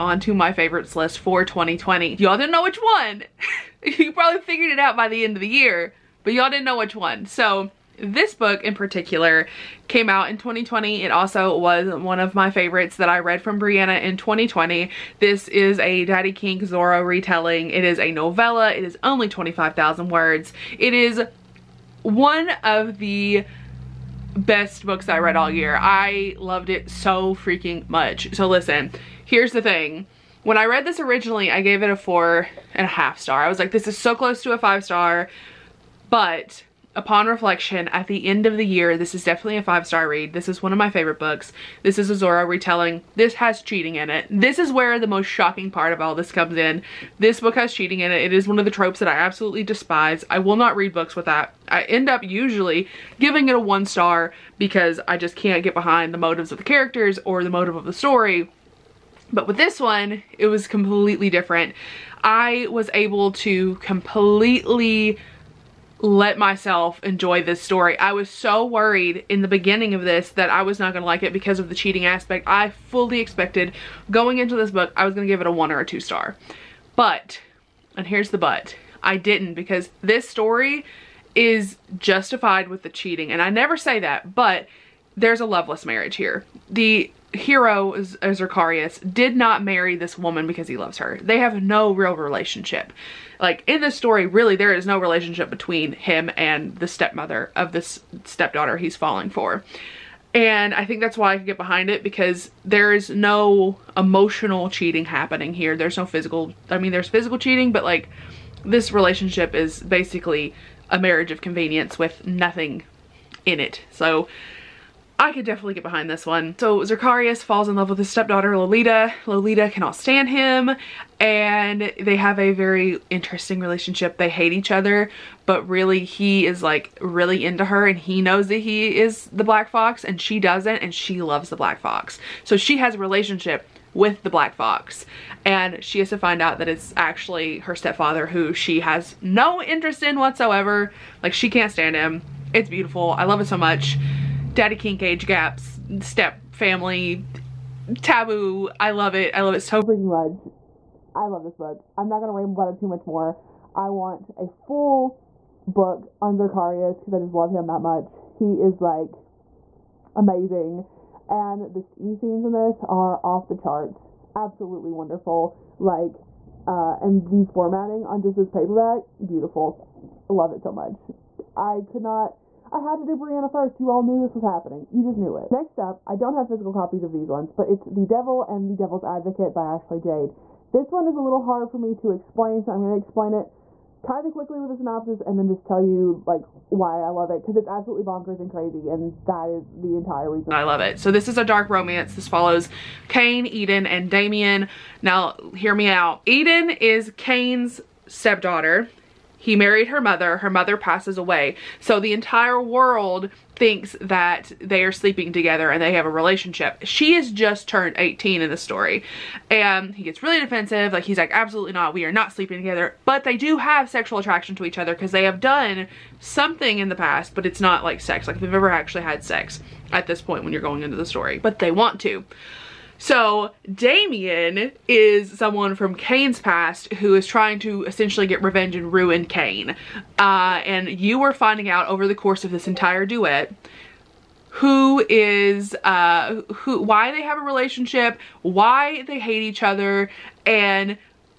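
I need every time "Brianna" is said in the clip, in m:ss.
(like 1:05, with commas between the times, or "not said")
0:13, 2:53.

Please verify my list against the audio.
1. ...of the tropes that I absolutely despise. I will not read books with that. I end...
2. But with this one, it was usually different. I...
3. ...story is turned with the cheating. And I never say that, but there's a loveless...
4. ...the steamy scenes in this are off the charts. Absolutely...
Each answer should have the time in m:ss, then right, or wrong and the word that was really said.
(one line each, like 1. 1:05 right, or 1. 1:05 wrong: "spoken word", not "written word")
1. 0:48 right
2. 0:59 wrong: "completely", not "usually"
3. 1:20 wrong: "justified", not "turned"
4. 2:41 right.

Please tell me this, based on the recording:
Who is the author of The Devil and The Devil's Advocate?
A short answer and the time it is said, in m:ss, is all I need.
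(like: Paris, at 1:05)
Ashley Jade, at 2:59.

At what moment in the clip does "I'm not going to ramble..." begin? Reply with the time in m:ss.
2:31.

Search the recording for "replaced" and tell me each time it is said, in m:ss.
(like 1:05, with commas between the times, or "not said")
not said.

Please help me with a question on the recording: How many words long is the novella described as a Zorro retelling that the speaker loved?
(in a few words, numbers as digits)
25,000.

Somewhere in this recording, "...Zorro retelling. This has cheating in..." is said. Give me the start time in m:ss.
0:42.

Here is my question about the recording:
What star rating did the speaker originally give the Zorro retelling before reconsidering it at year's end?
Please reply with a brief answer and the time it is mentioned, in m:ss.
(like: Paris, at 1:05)
four and a half star, at 0:31.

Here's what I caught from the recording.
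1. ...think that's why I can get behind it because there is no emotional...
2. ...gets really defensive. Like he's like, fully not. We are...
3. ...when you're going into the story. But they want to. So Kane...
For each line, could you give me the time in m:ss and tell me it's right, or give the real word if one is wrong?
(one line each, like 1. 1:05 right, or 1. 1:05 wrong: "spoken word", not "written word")
1. 1:40 right
2. 3:30 wrong: "absolutely", not "fully"
3. 3:40 wrong: "Damien", not "Kane".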